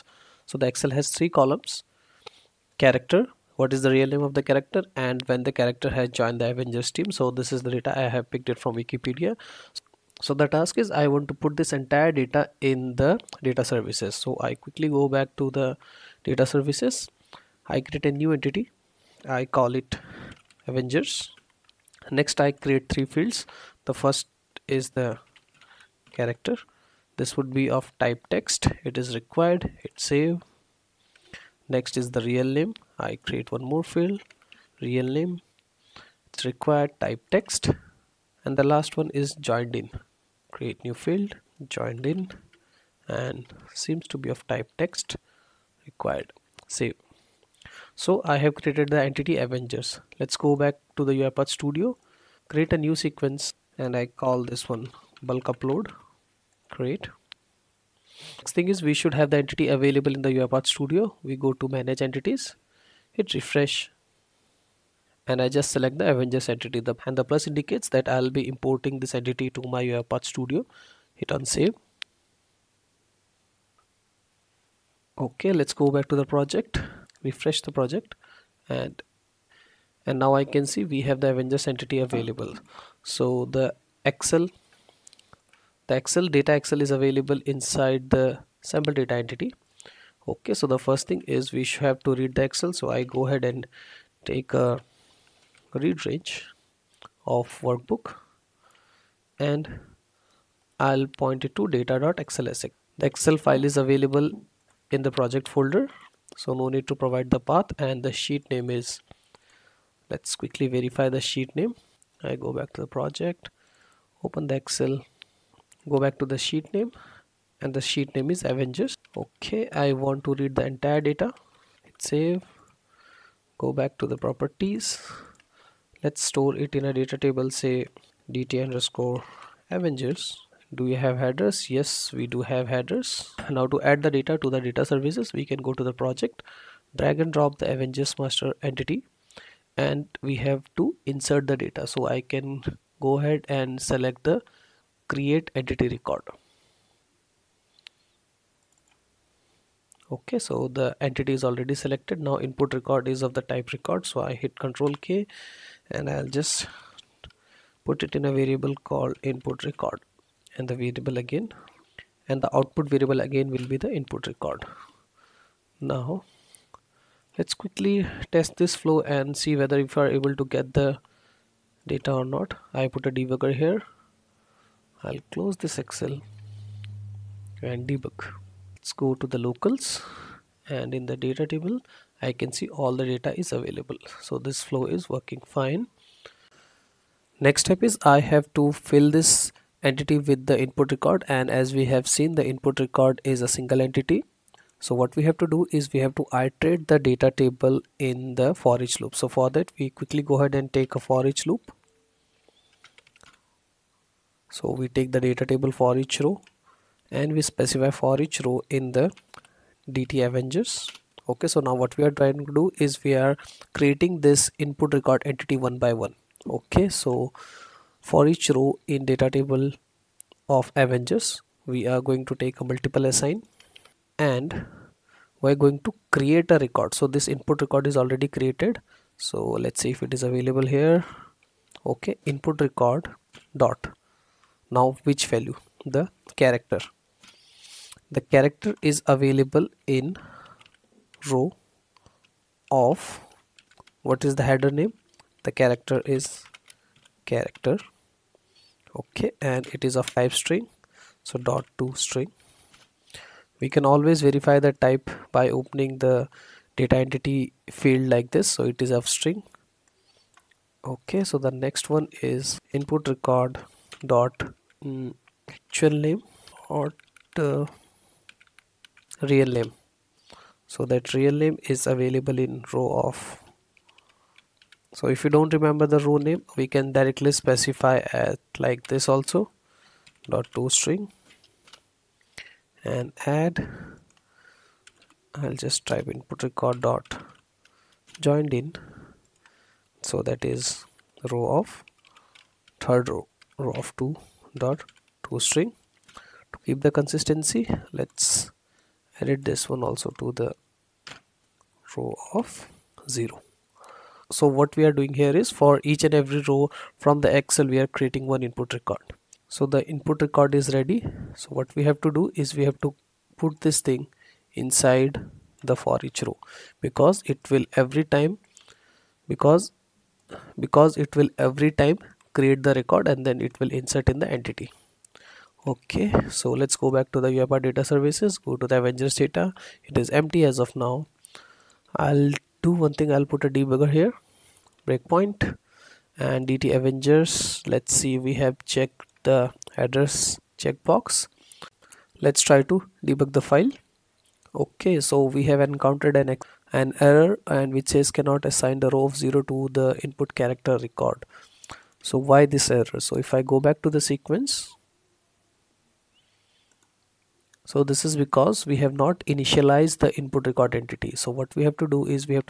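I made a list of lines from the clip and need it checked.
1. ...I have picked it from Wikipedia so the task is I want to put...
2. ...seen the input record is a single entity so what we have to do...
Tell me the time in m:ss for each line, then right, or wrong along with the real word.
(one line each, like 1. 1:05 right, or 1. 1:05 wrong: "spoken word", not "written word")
1. 0:07 right
2. 3:12 right.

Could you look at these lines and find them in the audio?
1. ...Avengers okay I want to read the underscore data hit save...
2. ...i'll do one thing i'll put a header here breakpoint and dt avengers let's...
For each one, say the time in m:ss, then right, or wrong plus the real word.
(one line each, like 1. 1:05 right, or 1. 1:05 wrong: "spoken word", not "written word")
1. 1:58 wrong: "entire", not "underscore"
2. 5:32 wrong: "debugger", not "header".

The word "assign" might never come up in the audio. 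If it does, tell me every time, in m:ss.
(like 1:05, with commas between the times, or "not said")
3:43, 5:48.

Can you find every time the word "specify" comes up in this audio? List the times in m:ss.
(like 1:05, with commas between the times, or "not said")
3:27, 4:37.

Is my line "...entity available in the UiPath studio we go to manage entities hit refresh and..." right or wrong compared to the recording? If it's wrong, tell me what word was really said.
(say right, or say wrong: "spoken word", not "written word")
right.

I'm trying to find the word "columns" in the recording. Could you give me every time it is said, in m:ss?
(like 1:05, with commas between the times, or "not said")
0:01.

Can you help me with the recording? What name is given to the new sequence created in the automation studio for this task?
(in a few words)
bulk upload Create.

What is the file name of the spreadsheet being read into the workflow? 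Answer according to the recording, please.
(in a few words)
data.xlsx.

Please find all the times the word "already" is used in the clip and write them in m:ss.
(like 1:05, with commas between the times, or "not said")
2:31, 3:47.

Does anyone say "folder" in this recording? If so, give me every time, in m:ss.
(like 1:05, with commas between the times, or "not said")
1:45.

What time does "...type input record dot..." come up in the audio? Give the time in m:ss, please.
4:45.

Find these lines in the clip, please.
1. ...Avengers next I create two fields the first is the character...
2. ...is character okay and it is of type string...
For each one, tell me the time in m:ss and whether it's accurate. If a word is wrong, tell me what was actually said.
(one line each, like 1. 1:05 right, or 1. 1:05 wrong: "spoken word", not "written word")
1. 0:20 wrong: "three", not "two"
2. 4:06 right.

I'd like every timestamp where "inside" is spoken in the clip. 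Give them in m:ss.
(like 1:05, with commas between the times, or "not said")
1:27, 5:14.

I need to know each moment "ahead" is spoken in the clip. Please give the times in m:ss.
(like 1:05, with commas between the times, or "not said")
1:33, 2:23, 3:20.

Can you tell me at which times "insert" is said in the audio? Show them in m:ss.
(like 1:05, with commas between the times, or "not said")
2:21, 5:23.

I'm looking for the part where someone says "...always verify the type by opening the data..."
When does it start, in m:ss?
4:13.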